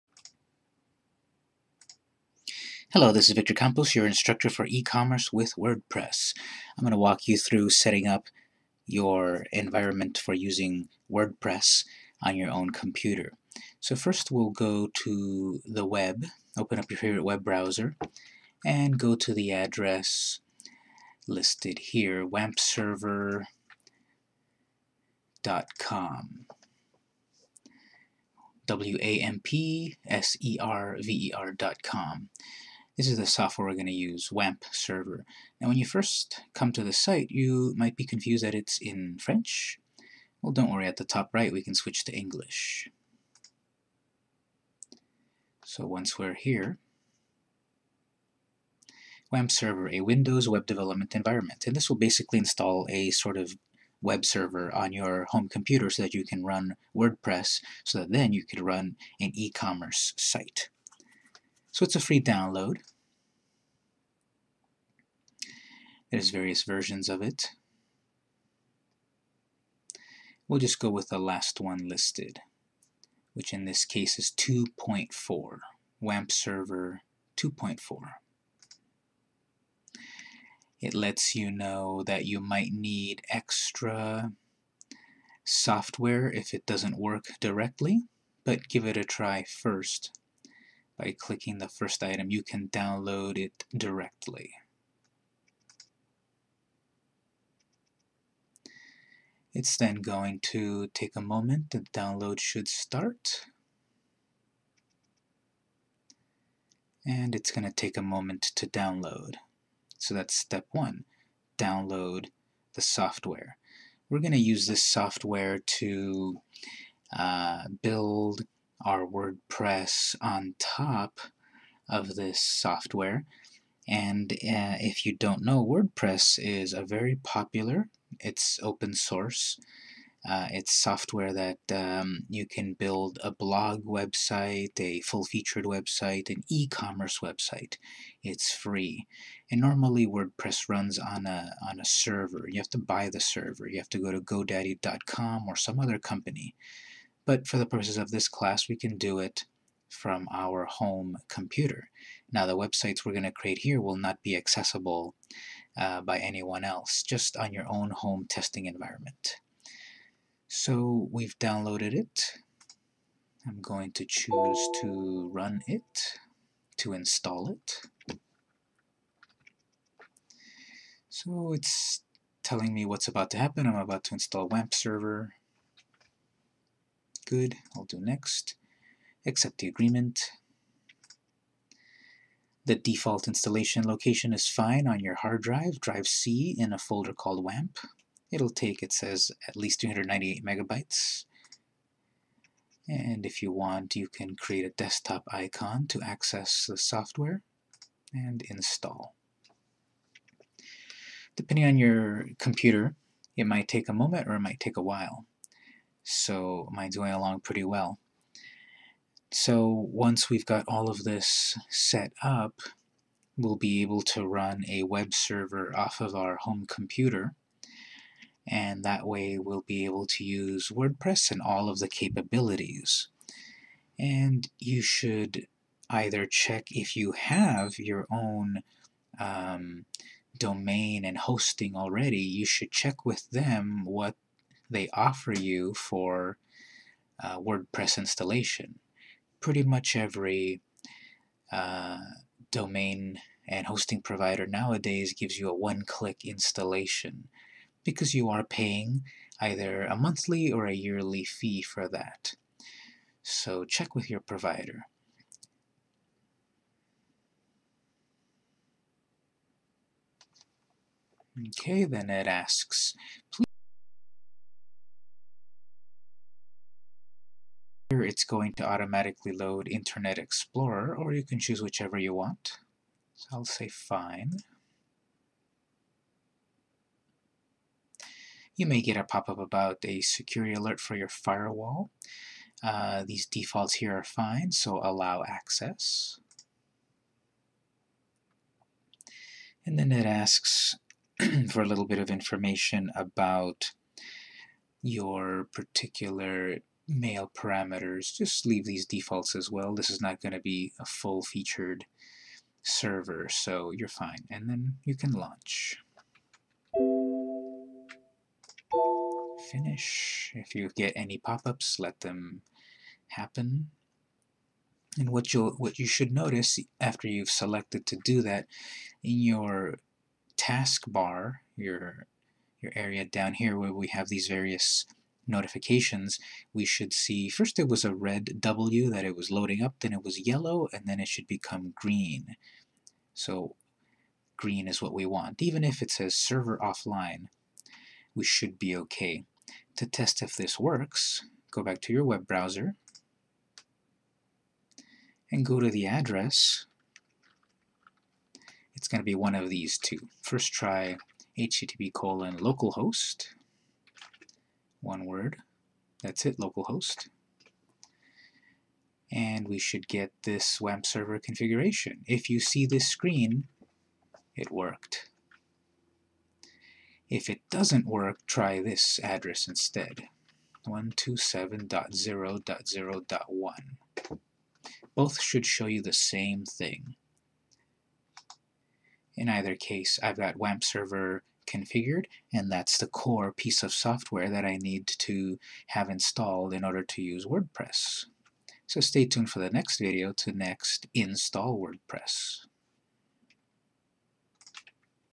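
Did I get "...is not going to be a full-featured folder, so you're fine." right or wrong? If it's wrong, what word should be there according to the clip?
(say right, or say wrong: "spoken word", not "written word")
wrong: "server", not "folder".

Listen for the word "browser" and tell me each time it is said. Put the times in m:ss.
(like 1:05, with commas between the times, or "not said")
0:17, 5:42.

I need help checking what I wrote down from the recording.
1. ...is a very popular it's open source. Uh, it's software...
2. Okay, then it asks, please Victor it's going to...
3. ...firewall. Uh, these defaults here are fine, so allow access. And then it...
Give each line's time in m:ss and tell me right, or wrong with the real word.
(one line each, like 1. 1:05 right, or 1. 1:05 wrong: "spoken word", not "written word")
1. 2:06 right
2. 4:21 wrong: "Here", not "Victor"
3. 4:41 right.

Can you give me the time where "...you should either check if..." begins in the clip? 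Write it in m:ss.
3:44.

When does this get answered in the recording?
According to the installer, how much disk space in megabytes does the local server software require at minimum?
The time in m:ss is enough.
3:09.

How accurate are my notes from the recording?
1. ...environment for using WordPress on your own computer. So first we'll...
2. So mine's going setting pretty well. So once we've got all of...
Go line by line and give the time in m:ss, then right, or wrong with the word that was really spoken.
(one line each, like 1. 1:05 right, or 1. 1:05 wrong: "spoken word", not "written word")
1. 0:09 right
2. 3:26 wrong: "along", not "setting".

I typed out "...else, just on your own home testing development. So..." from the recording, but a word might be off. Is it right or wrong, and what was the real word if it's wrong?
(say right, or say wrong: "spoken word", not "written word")
wrong: "environment", not "development".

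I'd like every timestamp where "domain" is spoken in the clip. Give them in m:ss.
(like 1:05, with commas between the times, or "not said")
3:50, 4:02.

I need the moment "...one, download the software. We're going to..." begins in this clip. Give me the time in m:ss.
1:50.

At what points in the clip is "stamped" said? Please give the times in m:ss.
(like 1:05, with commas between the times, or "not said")
not said.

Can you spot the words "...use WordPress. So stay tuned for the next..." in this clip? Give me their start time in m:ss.
6:27.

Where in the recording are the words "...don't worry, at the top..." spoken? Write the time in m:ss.
0:40.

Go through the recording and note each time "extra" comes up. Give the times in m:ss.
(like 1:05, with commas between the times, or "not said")
1:23.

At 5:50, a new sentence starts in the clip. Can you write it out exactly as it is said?
First try http colon localhost one word.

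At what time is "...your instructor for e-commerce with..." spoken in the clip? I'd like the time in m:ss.
0:03.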